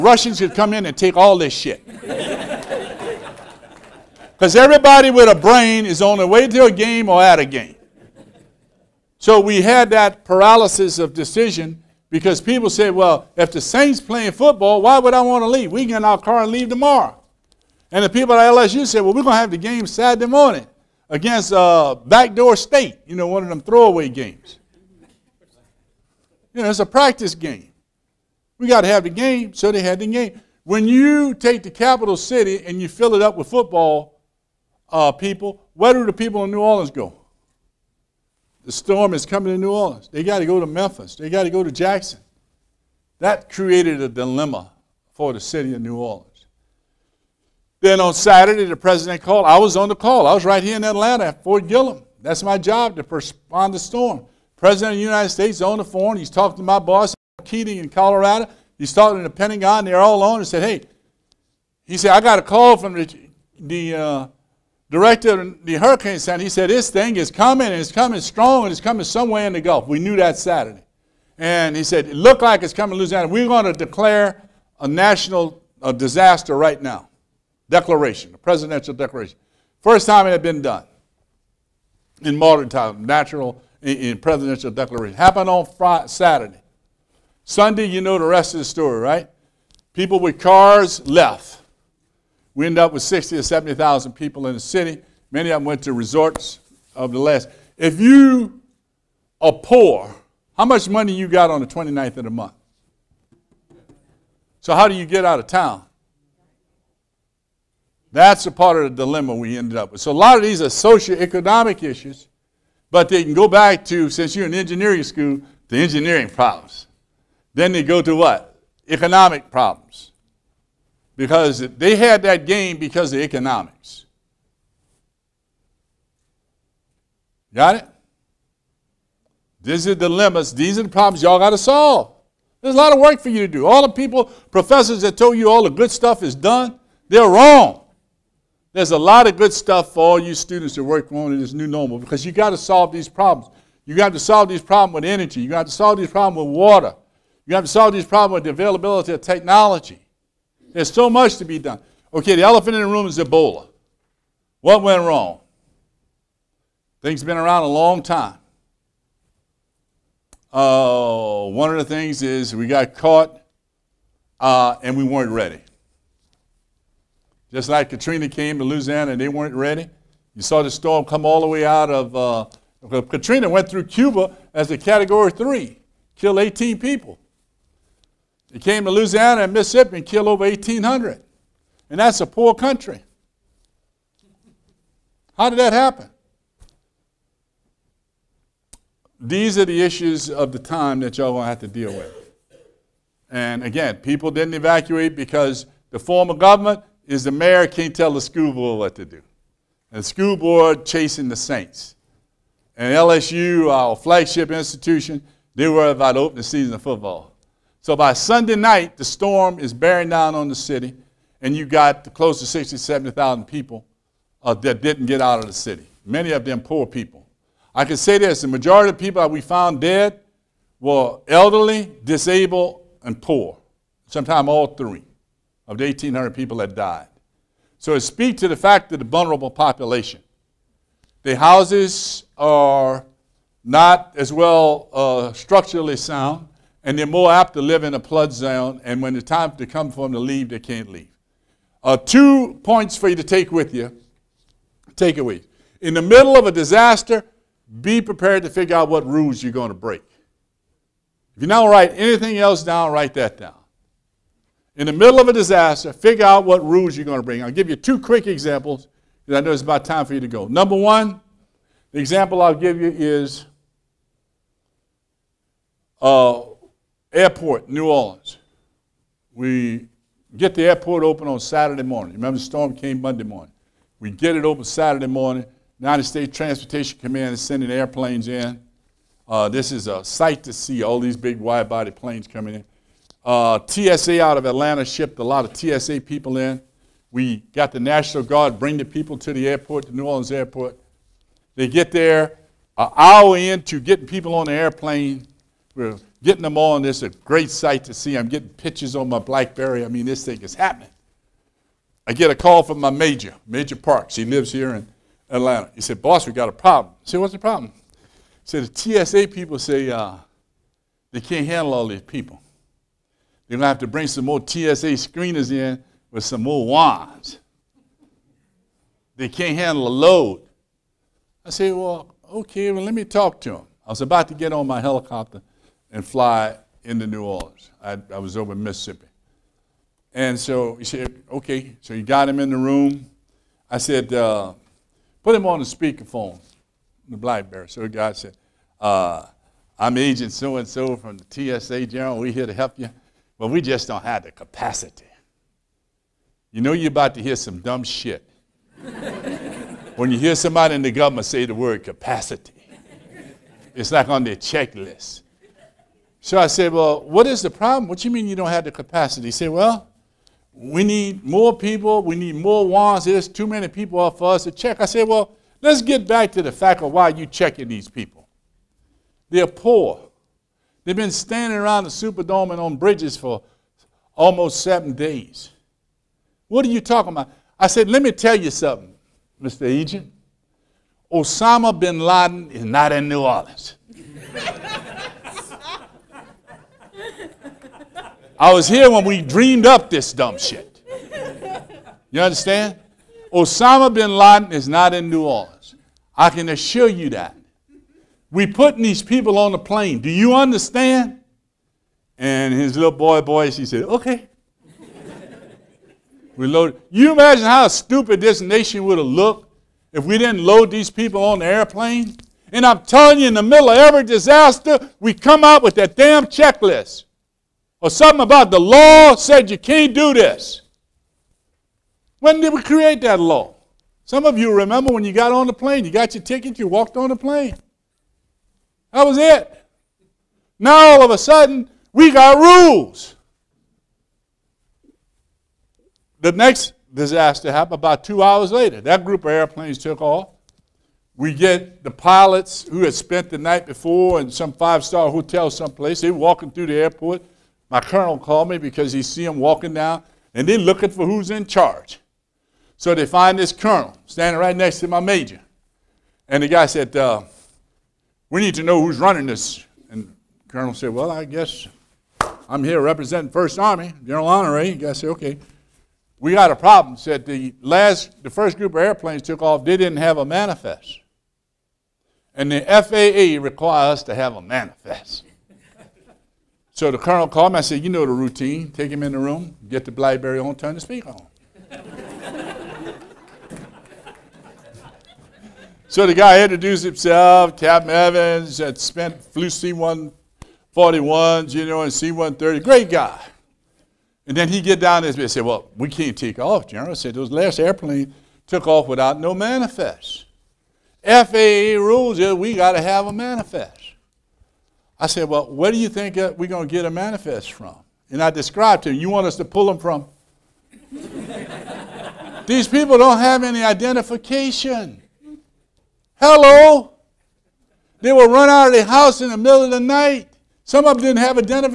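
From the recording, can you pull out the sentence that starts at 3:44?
Sometimes all three of the 1,800 people that died.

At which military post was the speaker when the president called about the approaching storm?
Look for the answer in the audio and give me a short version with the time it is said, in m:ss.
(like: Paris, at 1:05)
Fort Gillem, at 0:51.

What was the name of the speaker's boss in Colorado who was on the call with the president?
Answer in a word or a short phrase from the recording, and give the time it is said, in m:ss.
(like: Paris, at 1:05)
Keating, at 0:57.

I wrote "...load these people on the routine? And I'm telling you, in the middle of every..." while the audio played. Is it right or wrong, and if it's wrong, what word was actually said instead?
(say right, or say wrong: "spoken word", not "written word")
wrong: "airplane", not "routine".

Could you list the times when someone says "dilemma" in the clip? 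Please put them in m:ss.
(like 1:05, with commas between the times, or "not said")
0:44, 1:49, 2:10.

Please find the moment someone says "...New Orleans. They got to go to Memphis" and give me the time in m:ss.
0:39.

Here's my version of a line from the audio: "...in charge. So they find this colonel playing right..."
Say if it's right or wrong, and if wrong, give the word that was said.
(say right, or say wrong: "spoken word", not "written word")
wrong: "standing", not "playing".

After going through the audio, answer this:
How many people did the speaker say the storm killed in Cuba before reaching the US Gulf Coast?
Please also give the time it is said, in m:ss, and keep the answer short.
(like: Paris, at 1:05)
18, at 2:56.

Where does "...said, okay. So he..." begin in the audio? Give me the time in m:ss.
5:30.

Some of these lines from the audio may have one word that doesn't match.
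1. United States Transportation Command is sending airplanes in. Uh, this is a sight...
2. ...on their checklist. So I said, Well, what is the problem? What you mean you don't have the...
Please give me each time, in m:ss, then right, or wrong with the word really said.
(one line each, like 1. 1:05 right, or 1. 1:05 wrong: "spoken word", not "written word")
1. 4:35 right
2. 5:54 right.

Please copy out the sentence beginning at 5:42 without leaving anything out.
We're here to help you, but we just don't have the capacity.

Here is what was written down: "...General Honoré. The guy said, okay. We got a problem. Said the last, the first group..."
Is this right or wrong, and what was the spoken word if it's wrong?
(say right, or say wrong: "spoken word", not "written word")
right.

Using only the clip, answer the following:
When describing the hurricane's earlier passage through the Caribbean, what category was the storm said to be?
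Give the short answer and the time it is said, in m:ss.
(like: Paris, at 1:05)
category 3, at 2:54.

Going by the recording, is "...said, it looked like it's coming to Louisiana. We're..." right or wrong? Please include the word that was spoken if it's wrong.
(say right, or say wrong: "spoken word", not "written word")
right.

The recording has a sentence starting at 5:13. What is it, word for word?
They're going to have to bring some more TSA screeners in with some more wands.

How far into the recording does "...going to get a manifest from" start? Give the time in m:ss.
8:26.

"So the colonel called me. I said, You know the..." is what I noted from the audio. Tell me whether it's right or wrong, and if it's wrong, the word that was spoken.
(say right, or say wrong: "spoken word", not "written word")
right.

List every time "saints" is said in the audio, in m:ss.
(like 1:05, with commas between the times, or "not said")
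0:13, 3:21.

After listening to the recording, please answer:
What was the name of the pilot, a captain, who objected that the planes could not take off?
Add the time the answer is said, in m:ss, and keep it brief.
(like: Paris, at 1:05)
Captain Evans, at 8:07.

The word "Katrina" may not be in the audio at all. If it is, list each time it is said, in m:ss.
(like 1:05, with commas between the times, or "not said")
2:47, 2:53.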